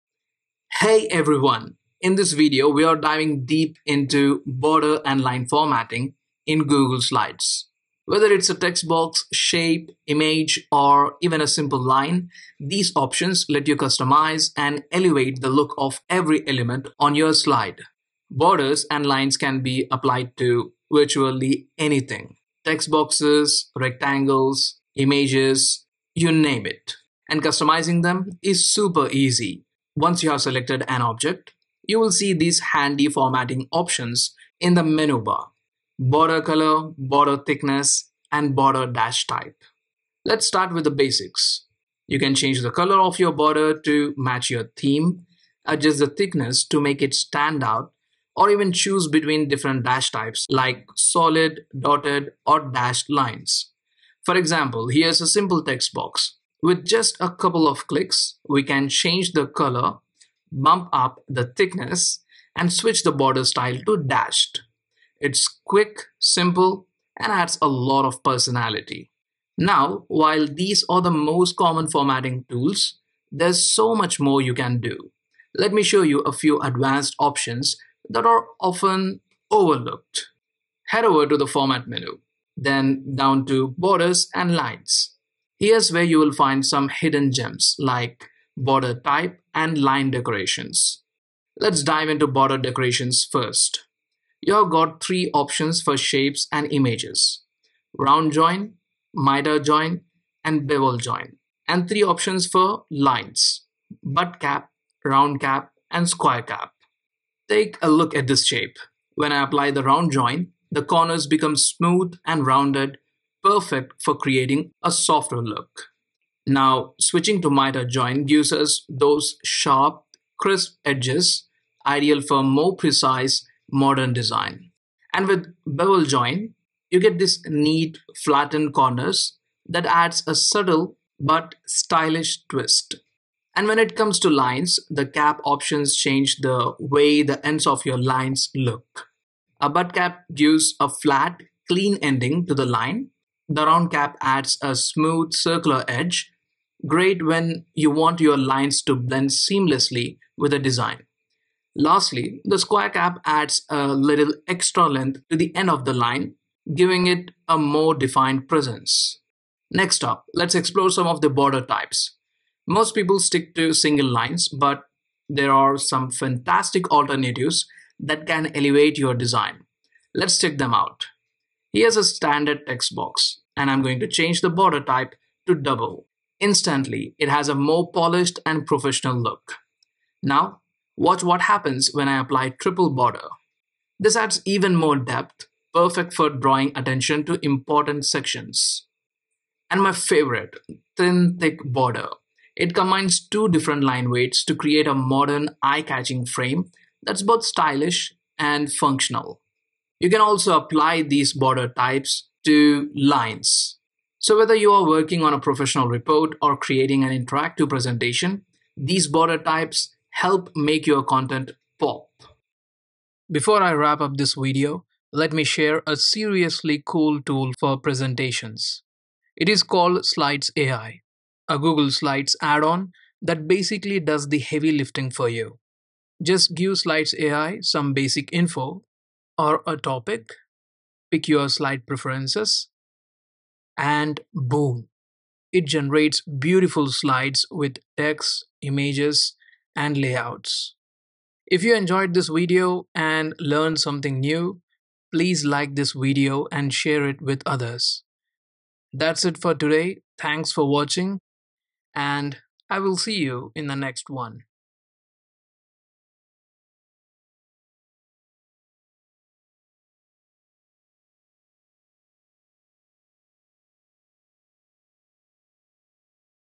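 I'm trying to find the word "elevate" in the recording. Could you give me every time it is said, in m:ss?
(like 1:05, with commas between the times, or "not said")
0:14, 2:48.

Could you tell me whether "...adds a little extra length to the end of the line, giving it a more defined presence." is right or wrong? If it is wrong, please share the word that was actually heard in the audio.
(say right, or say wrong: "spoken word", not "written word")
right.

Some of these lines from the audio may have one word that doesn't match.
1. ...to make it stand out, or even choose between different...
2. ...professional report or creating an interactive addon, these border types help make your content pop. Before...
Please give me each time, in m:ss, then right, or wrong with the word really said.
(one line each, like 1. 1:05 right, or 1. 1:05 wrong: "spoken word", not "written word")
1. 0:46 right
2. 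3:25 wrong: "presentation", not "addon".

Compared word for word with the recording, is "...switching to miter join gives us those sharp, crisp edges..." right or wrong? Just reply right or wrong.
right.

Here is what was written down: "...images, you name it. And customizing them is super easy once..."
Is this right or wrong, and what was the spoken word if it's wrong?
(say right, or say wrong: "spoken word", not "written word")
right.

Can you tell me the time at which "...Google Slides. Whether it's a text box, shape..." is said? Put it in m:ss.
0:06.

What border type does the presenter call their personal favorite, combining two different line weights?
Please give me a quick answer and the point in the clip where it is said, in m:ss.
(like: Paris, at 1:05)
Thin thick, at 3:10.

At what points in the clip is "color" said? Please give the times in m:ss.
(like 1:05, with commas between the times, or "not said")
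0:36, 0:42, 0:59.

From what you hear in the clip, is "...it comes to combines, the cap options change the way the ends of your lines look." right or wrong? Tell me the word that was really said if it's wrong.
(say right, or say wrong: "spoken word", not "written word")
wrong: "lines", not "combines".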